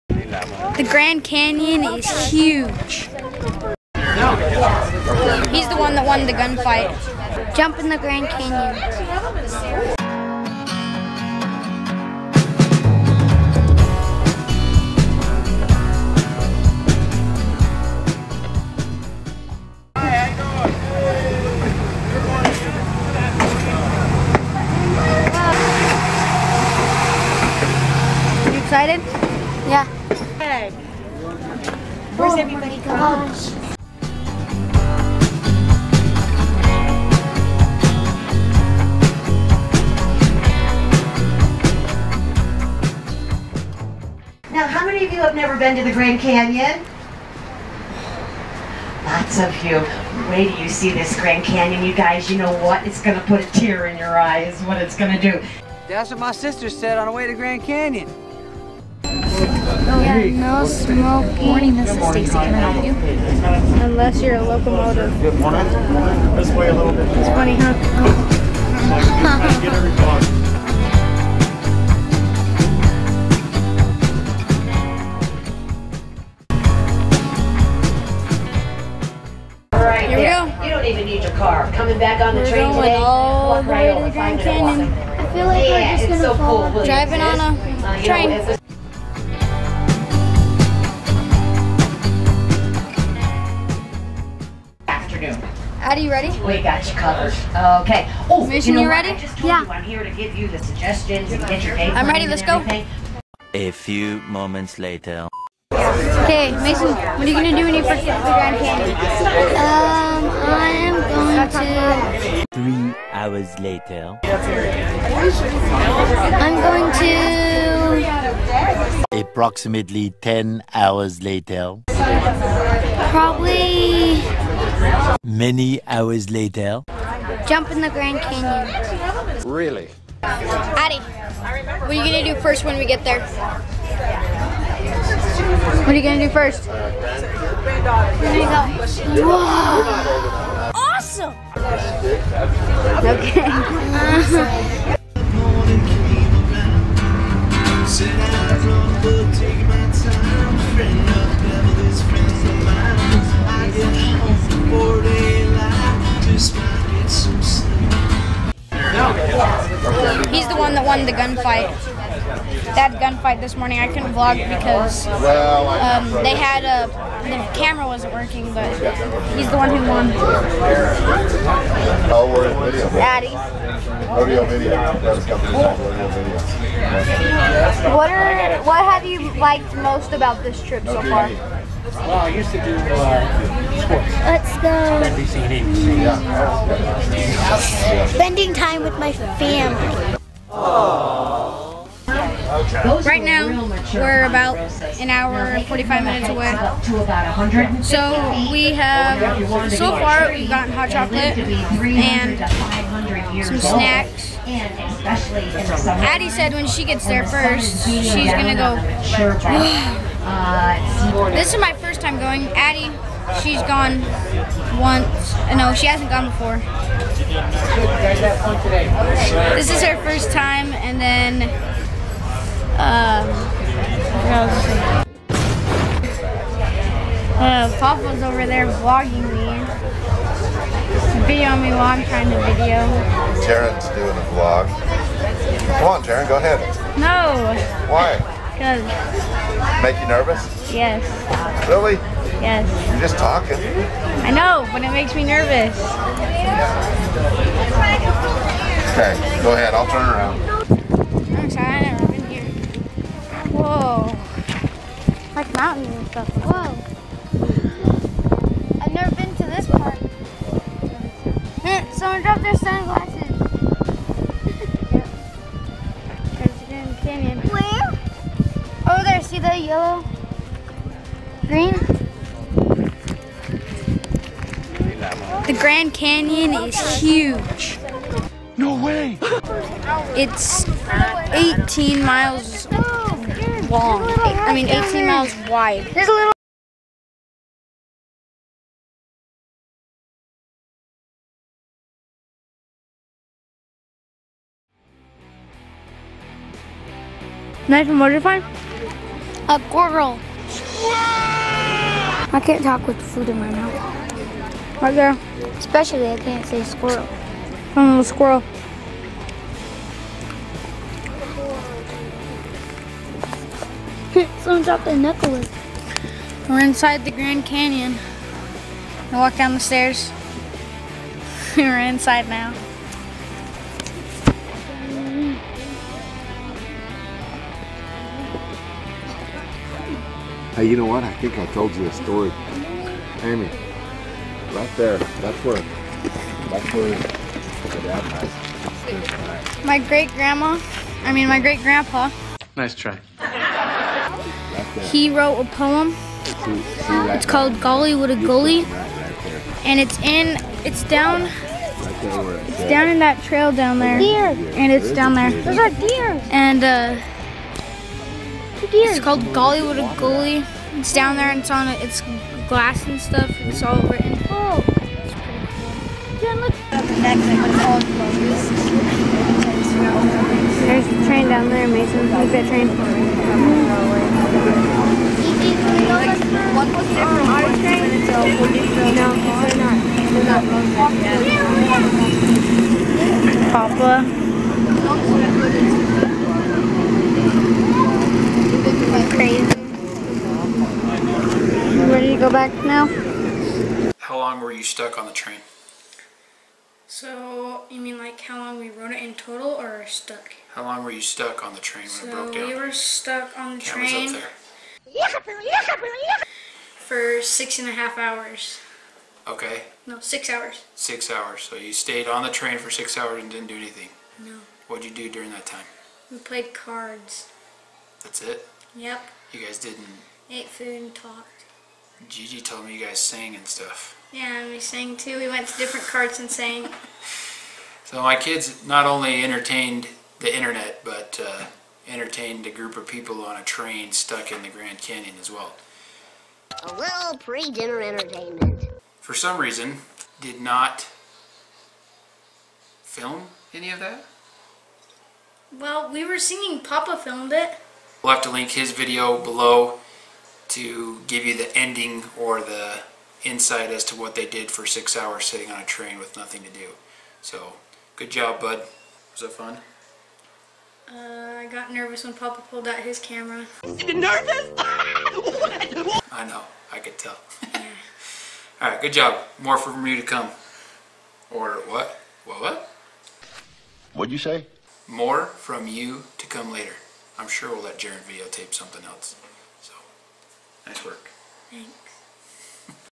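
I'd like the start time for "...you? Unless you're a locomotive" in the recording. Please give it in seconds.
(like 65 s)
62 s.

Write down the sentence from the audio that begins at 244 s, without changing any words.
I know, but it makes me nervous.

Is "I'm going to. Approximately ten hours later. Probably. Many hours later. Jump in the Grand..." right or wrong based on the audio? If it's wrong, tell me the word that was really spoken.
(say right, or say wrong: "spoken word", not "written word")
right.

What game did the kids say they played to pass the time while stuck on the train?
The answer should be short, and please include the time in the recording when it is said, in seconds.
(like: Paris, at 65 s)
Cards, at 416 s.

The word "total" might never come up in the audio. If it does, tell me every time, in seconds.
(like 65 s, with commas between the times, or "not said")
399 s.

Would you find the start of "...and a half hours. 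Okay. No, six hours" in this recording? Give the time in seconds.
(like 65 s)
407 s.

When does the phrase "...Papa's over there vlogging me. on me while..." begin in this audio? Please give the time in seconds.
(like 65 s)
227 s.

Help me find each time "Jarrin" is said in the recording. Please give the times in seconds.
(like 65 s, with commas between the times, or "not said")
233 s, 477 s.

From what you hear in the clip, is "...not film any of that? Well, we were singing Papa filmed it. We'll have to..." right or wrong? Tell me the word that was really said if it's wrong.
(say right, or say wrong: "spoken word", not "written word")
right.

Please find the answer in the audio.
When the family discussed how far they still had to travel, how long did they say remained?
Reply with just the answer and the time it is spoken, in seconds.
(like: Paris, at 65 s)
1 hour and 45 minutes, at 194 s.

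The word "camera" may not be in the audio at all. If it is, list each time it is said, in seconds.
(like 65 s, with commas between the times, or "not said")
167 s, 403 s, 462 s.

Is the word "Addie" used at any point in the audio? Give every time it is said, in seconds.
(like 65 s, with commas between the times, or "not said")
204 s, 212 s.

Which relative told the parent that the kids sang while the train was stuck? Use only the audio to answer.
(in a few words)
Gigi.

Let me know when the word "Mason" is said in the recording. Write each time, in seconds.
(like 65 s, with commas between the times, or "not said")
106 s, 371 s.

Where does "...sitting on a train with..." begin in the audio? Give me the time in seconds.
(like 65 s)
455 s.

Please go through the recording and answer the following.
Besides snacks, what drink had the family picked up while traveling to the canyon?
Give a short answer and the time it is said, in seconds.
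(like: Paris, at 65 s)
Hot chocolate, at 200 s.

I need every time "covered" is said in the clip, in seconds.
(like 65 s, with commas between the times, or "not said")
96 s.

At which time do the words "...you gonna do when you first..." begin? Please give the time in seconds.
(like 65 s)
107 s.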